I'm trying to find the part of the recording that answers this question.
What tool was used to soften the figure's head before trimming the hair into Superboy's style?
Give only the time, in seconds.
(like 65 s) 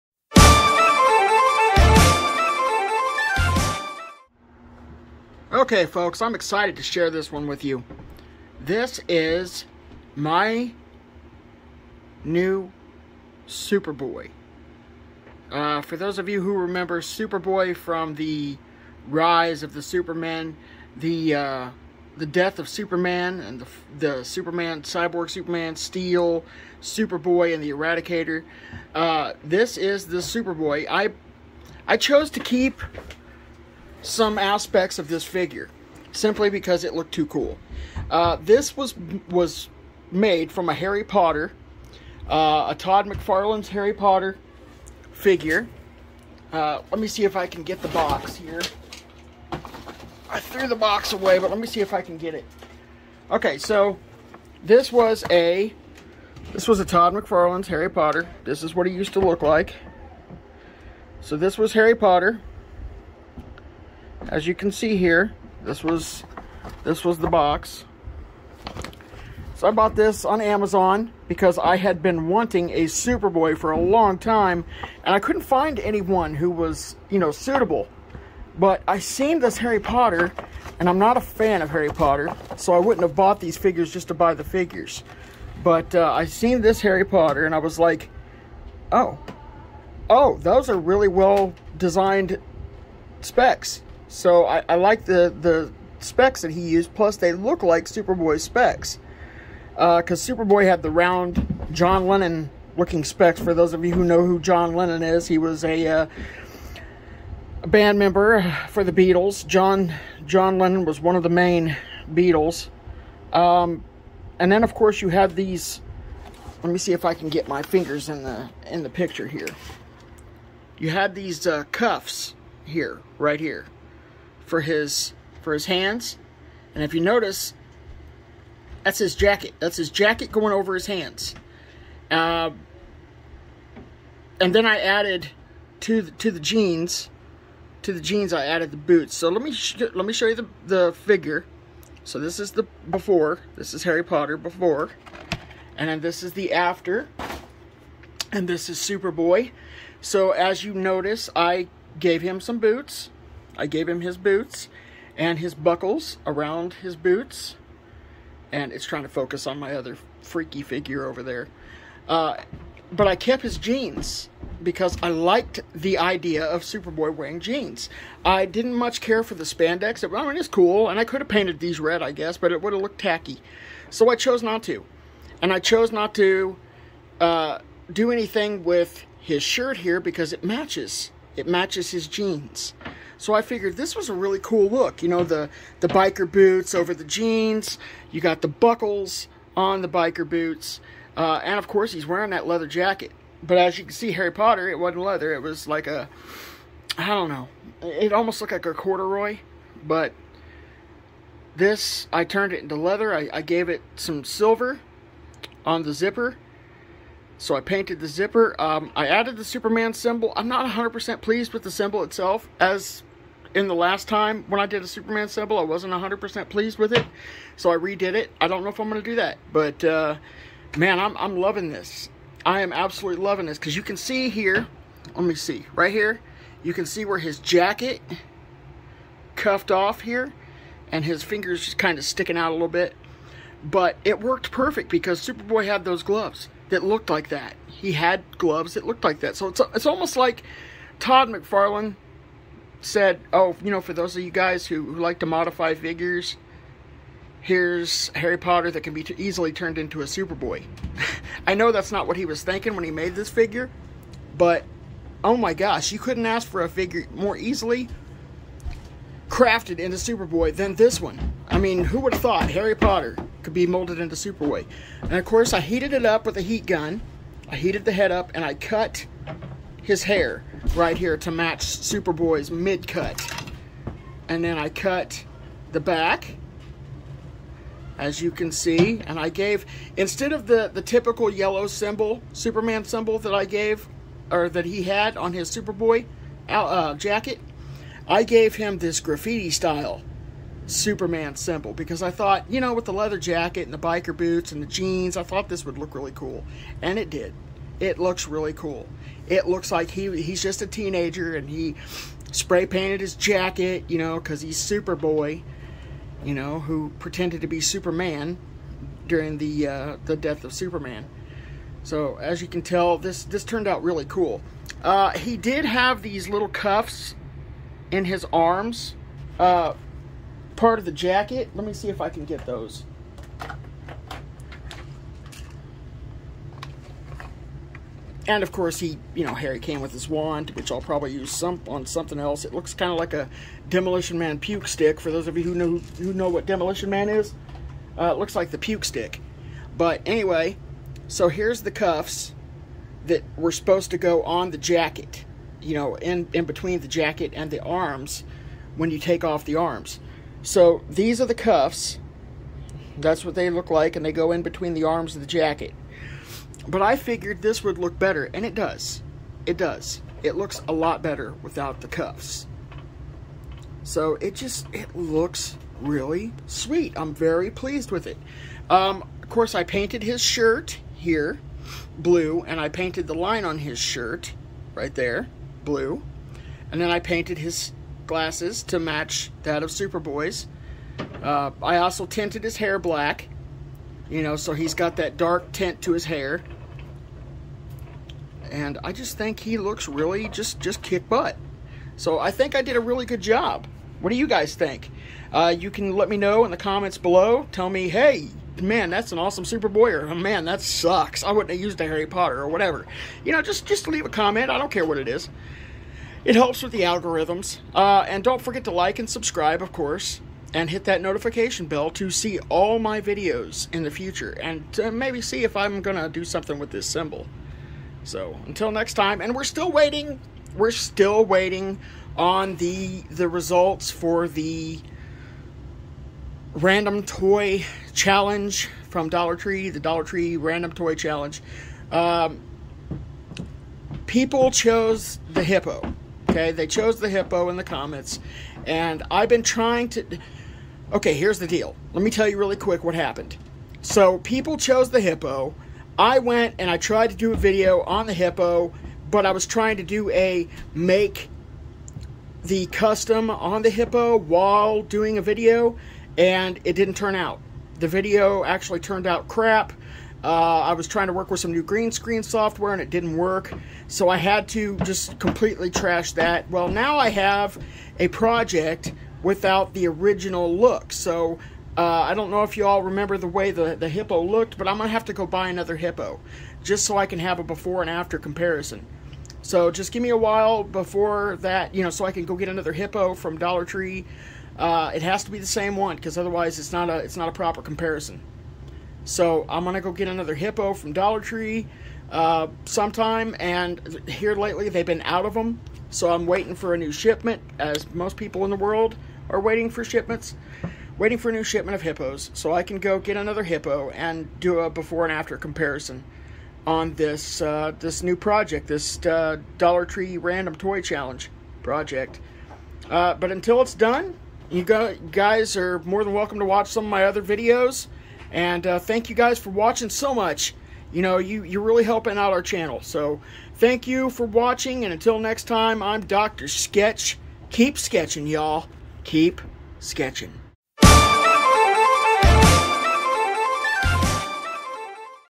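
266 s.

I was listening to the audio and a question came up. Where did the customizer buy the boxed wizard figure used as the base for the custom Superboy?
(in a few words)
Amazon.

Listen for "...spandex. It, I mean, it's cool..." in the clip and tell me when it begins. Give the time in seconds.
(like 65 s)
169 s.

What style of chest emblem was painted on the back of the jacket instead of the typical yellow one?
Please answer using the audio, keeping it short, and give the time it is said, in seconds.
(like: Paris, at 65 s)
Graffiti style, at 288 s.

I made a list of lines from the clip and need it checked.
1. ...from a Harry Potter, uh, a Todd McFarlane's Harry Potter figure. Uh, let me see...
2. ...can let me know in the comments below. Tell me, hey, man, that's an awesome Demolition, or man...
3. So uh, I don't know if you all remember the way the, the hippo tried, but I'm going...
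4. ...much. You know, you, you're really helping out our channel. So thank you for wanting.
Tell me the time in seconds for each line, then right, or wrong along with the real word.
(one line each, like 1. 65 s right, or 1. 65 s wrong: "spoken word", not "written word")
1. 40 s right
2. 395 s wrong: "Superboy", not "Demolition"
3. 470 s wrong: "looked", not "tried"
4. 520 s wrong: "watching", not "wanting".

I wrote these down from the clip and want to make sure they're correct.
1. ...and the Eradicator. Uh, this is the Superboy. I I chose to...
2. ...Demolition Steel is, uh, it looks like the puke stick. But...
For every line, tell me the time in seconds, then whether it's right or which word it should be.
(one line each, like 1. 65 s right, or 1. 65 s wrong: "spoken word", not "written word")
1. 27 s right
2. 336 s wrong: "Man", not "Steel".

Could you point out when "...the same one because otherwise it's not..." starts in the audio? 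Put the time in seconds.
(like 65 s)
485 s.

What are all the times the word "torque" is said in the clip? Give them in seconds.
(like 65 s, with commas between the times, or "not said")
not said.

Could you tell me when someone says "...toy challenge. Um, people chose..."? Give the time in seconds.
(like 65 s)
430 s.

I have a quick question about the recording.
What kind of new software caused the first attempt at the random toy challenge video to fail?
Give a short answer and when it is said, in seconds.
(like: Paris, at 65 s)
Green screen software, at 461 s.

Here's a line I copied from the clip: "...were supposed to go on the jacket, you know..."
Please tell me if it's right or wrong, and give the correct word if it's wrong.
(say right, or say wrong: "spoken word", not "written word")
right.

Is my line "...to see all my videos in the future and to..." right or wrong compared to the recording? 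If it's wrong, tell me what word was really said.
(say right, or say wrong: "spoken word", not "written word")
right.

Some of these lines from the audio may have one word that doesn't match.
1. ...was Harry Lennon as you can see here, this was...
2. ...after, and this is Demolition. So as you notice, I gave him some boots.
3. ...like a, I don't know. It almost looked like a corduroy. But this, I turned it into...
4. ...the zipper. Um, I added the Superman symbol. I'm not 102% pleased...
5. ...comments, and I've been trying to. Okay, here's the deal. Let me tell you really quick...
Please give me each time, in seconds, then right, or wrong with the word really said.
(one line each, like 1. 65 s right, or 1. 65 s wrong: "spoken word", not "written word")
1. 61 s wrong: "Potter", not "Lennon"
2. 146 s wrong: "Superboy", not "Demolition"
3. 195 s right
4. 207 s wrong: "100", not "102"
5. 437 s right.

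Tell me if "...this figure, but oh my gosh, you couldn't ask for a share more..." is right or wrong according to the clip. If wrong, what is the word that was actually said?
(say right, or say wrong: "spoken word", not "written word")
wrong: "figure", not "share".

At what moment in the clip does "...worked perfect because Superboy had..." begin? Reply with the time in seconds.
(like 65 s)
234 s.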